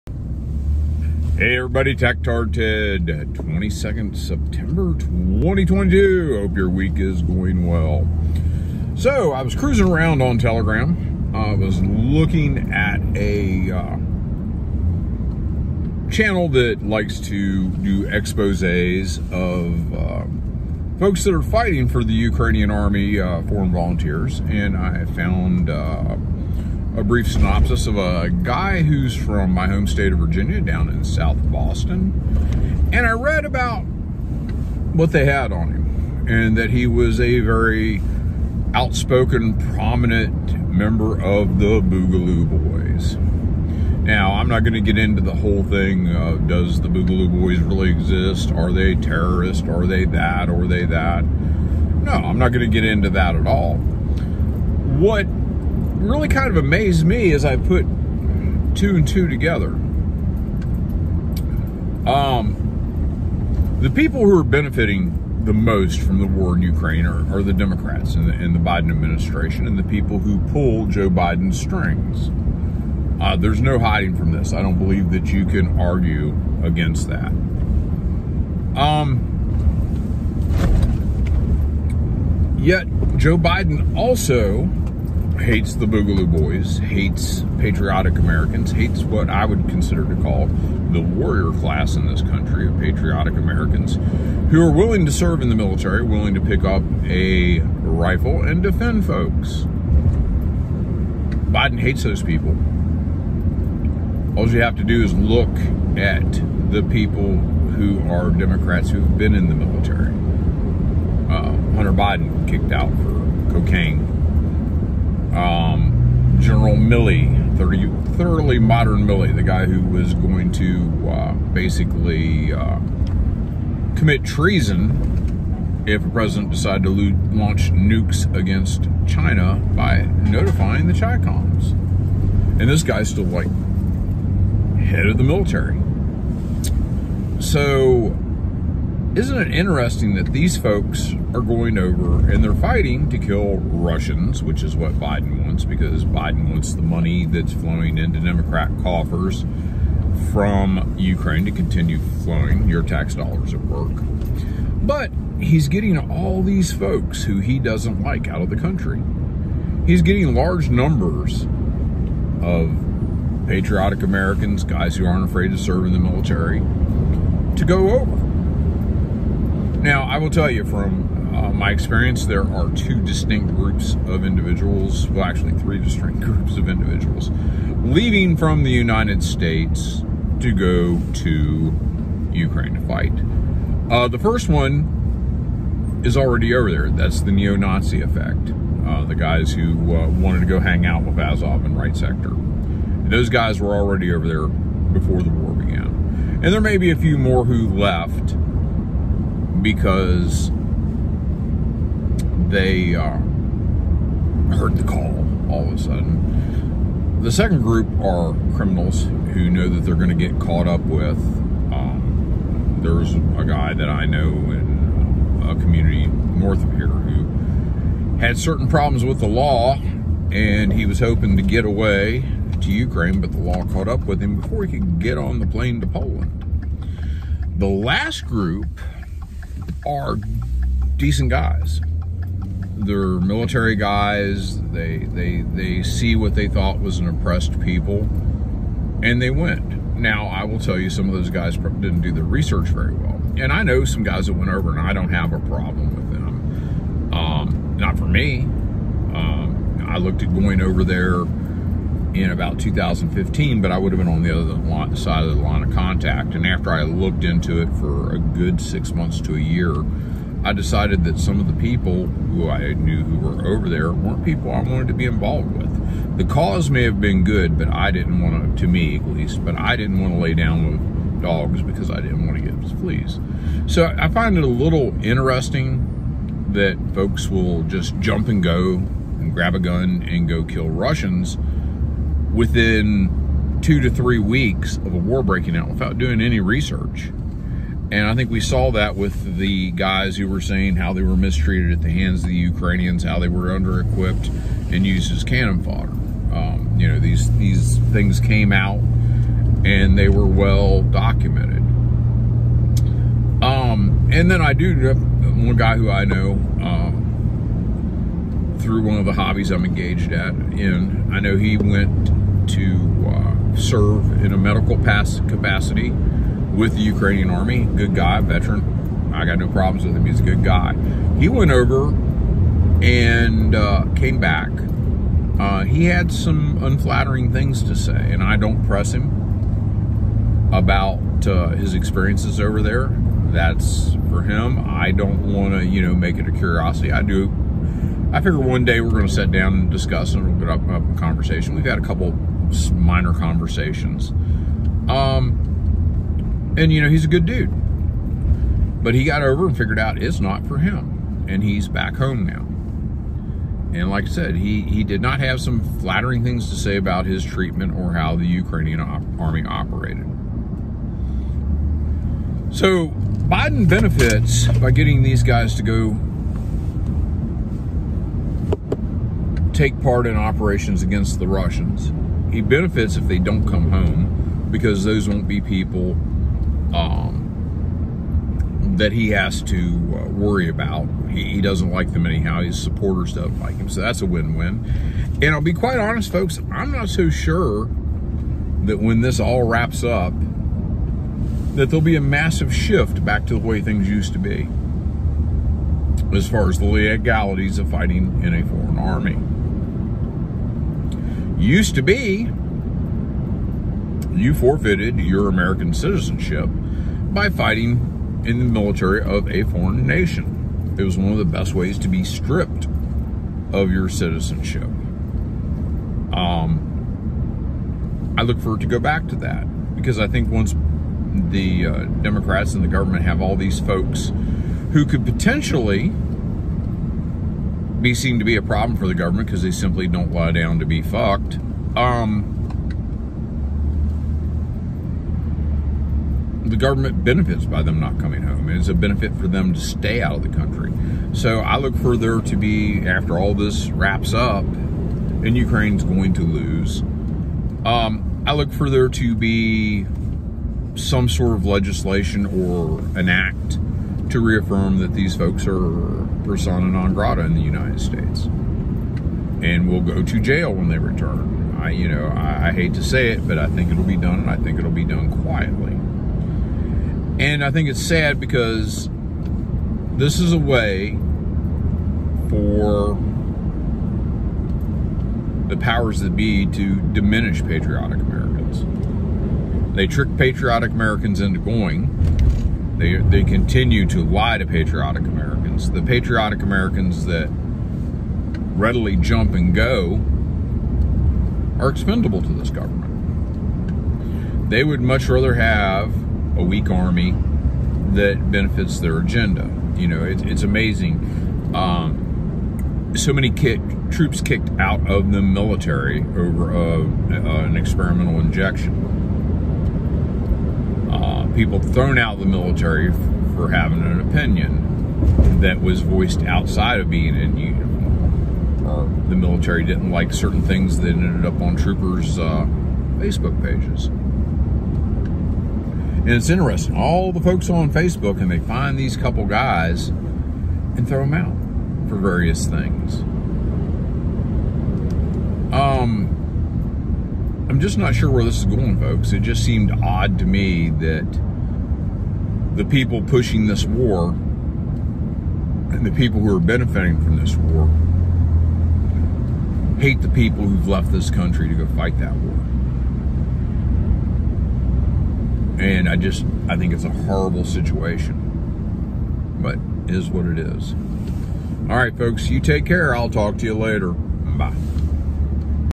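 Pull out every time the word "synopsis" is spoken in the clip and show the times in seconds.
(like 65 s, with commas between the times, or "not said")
27 s.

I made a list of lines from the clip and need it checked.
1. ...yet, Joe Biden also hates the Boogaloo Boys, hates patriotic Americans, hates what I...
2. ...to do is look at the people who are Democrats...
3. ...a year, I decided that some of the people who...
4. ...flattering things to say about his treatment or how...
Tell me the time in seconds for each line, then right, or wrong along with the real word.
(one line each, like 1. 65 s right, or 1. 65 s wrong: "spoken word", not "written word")
1. 82 s right
2. 104 s right
3. 259 s right
4. 355 s right.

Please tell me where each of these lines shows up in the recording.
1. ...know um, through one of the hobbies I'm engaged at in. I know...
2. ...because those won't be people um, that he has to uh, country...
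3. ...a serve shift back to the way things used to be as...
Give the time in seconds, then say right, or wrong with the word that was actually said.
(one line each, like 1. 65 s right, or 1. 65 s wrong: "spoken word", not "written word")
1. 306 s right
2. 374 s wrong: "worry", not "country"
3. 391 s wrong: "massive", not "serve".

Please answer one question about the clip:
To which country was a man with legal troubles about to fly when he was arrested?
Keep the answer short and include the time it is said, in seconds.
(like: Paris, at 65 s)
Poland, at 225 s.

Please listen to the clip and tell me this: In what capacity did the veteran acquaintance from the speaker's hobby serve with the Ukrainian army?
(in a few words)
medical.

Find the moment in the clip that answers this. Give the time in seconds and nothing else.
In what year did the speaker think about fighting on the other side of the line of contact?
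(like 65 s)
252 s.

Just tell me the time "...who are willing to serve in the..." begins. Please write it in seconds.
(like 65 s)
94 s.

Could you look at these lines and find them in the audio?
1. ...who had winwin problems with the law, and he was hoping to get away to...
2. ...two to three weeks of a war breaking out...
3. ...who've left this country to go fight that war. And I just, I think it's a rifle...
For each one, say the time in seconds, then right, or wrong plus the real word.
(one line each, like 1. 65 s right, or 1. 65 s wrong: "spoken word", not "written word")
1. 216 s wrong: "certain", not "winwin"
2. 283 s right
3. 550 s wrong: "horrible", not "rifle".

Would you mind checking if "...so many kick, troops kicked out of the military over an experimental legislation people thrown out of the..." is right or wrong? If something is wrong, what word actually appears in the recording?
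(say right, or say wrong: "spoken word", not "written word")
wrong: "injection", not "legislation".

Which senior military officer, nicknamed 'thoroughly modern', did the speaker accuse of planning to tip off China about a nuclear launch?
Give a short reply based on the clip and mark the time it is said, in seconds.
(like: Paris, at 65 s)
General Milley, at 116 s.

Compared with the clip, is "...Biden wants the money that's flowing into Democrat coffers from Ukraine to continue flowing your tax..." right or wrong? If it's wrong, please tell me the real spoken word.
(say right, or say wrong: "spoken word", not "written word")
right.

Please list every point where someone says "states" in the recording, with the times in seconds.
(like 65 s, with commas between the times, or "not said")
29 s, 179 s, 457 s.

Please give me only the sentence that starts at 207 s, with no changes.
The second group are criminals who know that they're going to get caught up with.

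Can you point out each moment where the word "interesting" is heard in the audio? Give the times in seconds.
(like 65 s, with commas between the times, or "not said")
139 s, 275 s, 526 s.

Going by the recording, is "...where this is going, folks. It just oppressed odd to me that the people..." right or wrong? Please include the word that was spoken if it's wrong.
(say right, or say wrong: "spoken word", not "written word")
wrong: "seemed", not "oppressed".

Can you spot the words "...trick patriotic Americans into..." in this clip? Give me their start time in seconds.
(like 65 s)
479 s.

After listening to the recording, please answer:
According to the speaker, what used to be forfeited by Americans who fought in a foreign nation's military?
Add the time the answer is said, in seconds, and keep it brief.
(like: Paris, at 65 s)
American citizenship, at 405 s.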